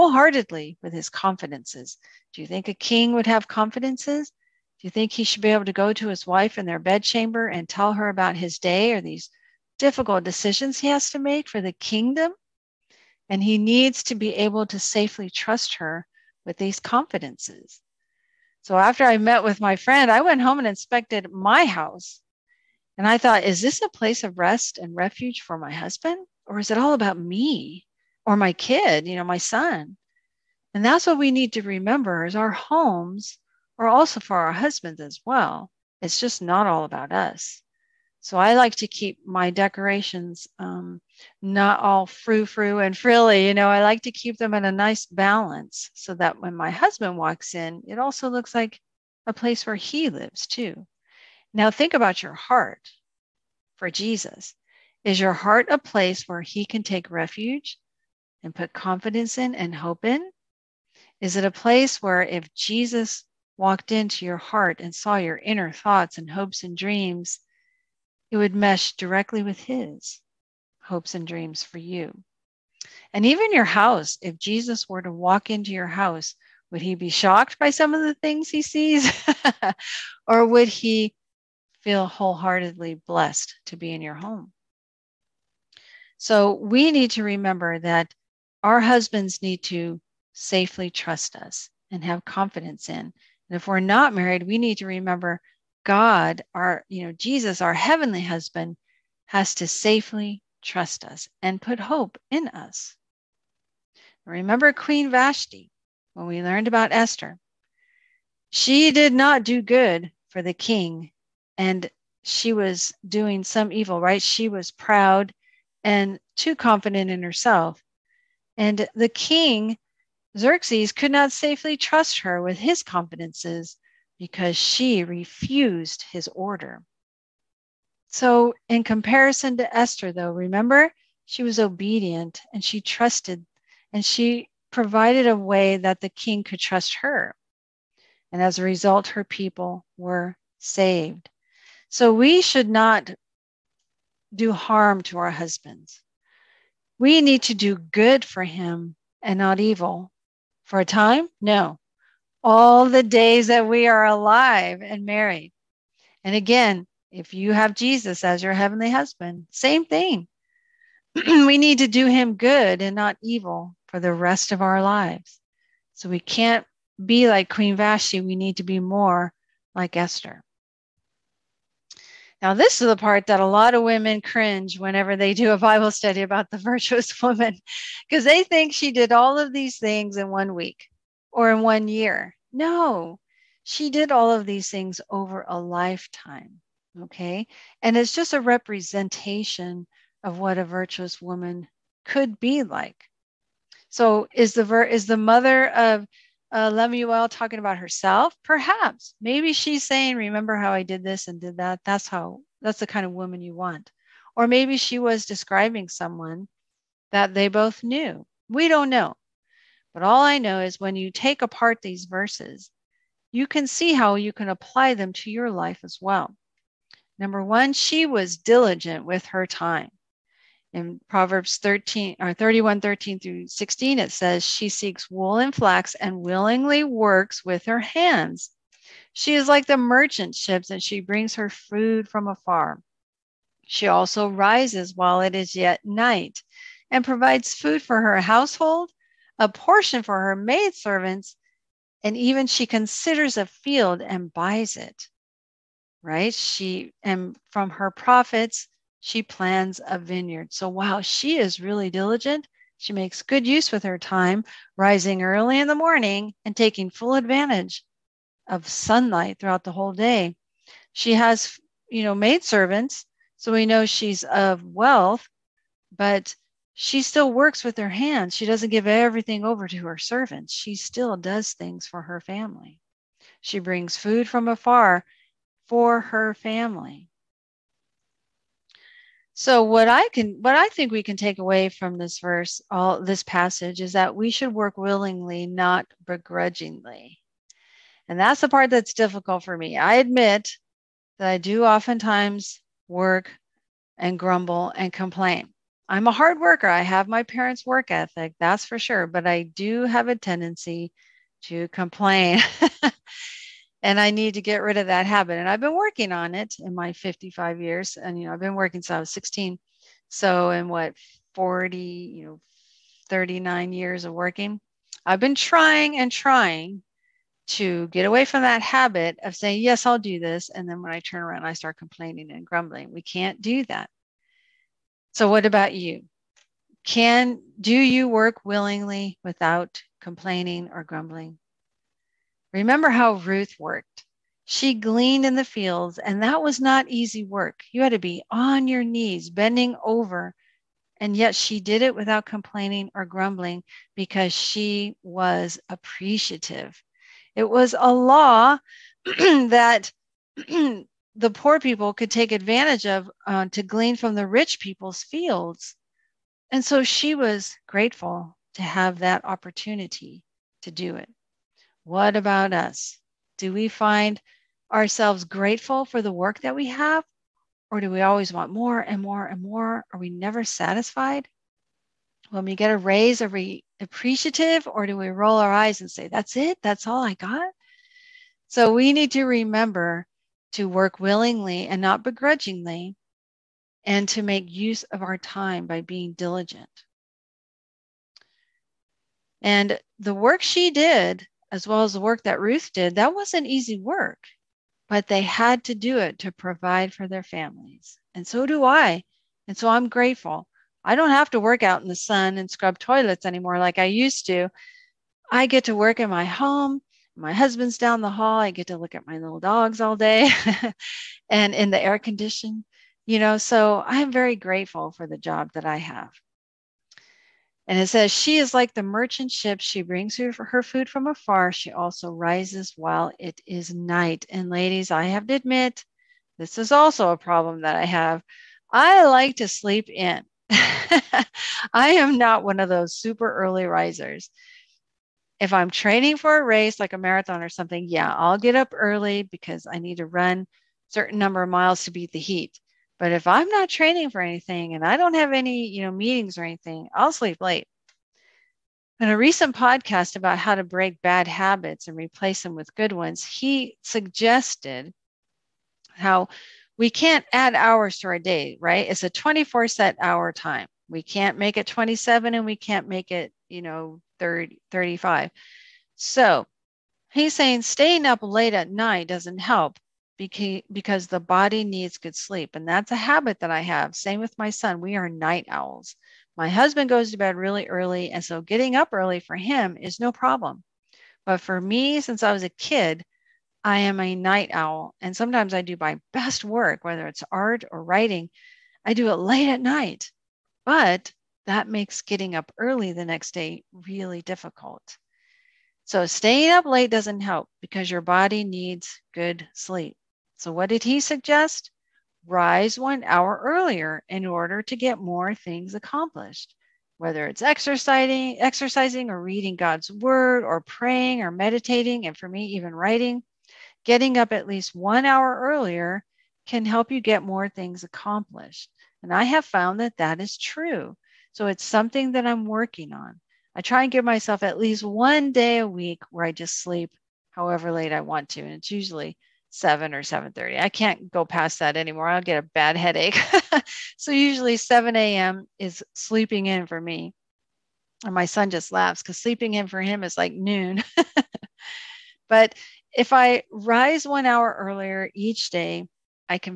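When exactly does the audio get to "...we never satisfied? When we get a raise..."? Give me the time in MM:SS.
06:09.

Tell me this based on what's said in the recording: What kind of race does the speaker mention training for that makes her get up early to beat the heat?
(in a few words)
a marathon.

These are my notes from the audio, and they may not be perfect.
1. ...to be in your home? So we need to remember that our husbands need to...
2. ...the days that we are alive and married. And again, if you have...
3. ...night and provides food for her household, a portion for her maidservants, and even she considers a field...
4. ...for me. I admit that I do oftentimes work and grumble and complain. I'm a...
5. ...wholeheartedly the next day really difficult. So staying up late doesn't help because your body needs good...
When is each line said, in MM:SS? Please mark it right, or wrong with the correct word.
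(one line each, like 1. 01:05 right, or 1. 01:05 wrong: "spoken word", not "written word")
1. 01:23 right
2. 02:32 right
3. 03:55 right
4. 04:49 right
5. 08:12 wrong: "early", not "wholeheartedly".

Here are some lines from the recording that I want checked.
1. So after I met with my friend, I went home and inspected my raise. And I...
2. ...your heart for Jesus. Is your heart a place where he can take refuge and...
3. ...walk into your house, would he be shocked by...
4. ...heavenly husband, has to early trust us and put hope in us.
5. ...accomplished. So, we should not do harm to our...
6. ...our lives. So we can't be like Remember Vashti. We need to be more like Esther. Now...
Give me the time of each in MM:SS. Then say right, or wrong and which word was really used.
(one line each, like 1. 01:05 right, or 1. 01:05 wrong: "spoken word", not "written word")
1. 00:18 wrong: "house", not "raise"
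2. 00:52 right
3. 01:15 right
4. 01:37 wrong: "safely", not "early"
5. 02:20 wrong: "saved", not "accomplished"
6. 02:44 wrong: "Queen", not "Remember".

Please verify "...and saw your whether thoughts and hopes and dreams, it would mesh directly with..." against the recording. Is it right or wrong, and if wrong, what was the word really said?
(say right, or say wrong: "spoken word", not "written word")
wrong: "inner", not "whether".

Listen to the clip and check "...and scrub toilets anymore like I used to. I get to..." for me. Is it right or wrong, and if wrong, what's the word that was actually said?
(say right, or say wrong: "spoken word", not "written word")
right.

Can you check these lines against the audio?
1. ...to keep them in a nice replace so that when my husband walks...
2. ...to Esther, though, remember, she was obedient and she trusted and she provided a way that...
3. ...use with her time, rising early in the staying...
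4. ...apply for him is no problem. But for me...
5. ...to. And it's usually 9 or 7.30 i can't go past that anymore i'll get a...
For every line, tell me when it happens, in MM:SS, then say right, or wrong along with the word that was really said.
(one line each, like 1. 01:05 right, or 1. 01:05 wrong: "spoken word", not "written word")
1. 00:44 wrong: "balance", not "replace"
2. 02:09 right
3. 04:13 wrong: "morning", not "staying"
4. 07:58 wrong: "early", not "apply"
5. 08:48 wrong: "7", not "9".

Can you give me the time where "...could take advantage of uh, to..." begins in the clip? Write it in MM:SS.
05:51.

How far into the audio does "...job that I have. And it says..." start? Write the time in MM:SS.
06:55.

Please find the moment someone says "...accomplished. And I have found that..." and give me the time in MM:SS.
08:37.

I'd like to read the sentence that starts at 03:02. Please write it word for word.
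No, she did all of these things over a lifetime.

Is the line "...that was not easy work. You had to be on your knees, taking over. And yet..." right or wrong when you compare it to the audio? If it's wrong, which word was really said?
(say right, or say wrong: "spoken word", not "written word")
wrong: "bending", not "taking".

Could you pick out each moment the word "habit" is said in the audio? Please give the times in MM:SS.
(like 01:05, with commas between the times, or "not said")
05:05, 05:18, 07:31, 07:52.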